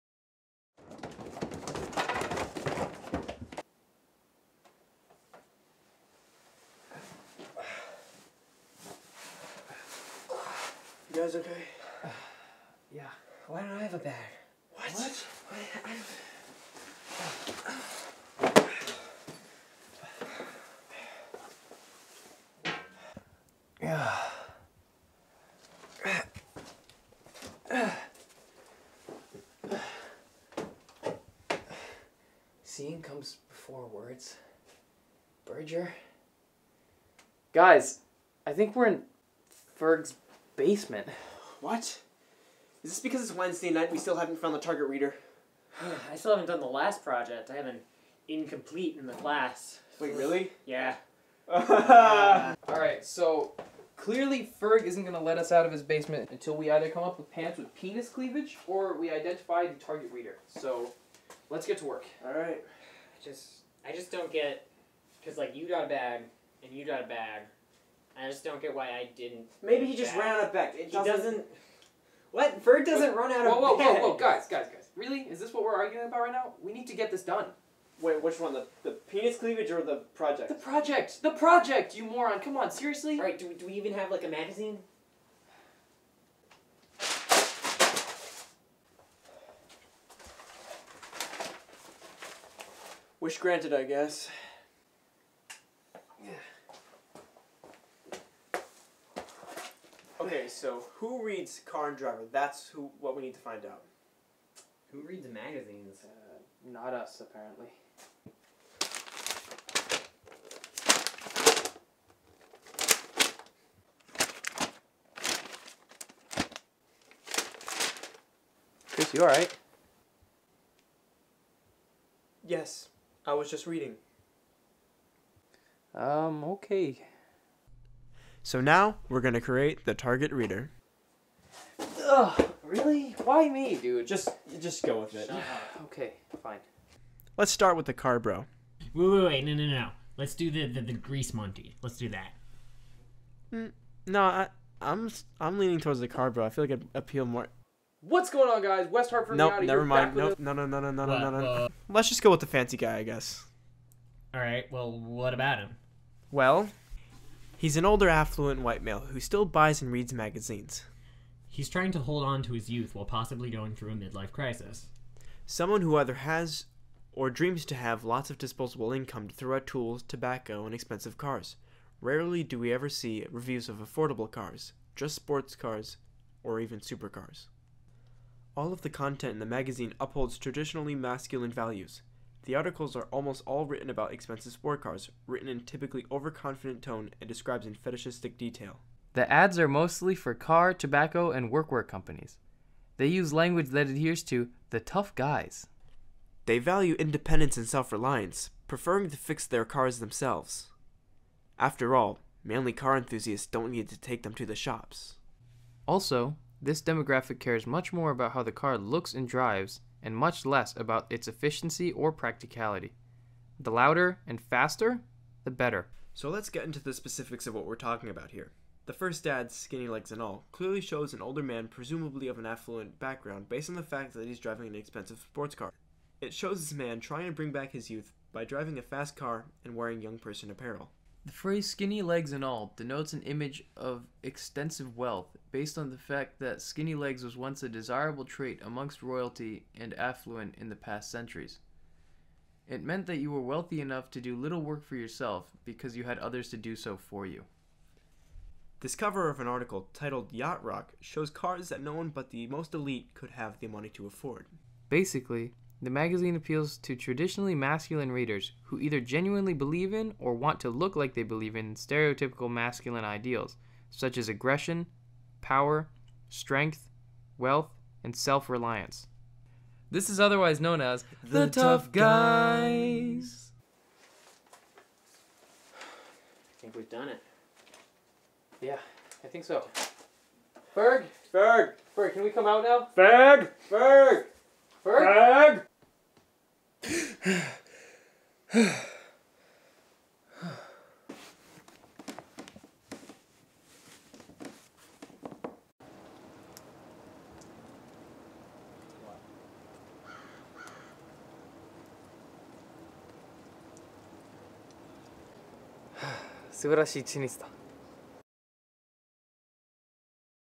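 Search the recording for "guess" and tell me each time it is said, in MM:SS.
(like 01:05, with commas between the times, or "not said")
01:33, 02:33.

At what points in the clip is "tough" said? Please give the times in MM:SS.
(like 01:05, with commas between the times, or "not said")
03:14, 04:31.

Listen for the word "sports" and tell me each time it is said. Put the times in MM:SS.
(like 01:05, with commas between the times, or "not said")
02:55, 03:04, 03:45.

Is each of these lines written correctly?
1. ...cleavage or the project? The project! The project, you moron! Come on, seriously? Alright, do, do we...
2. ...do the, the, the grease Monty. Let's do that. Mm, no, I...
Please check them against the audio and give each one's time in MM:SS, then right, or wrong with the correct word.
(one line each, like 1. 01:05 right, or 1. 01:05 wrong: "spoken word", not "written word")
1. 01:19 right
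2. 02:20 right.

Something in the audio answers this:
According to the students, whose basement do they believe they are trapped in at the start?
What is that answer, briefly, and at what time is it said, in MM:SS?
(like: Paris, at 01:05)
Ferg's basement, at 00:39.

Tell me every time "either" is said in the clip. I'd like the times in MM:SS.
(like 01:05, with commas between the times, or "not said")
00:56, 02:45, 04:18.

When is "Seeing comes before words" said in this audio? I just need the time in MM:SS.
00:32.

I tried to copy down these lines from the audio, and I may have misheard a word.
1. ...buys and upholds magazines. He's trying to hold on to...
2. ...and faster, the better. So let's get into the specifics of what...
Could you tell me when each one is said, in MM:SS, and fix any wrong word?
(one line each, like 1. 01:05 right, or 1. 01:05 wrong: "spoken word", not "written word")
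1. 02:39 wrong: "reads", not "upholds"
2. 03:34 right.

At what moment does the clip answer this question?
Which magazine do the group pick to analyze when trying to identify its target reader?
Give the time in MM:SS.
01:41.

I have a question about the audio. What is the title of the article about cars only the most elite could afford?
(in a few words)
Yacht Rock.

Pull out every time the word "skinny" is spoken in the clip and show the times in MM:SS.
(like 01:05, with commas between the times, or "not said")
03:39, 03:51, 03:56.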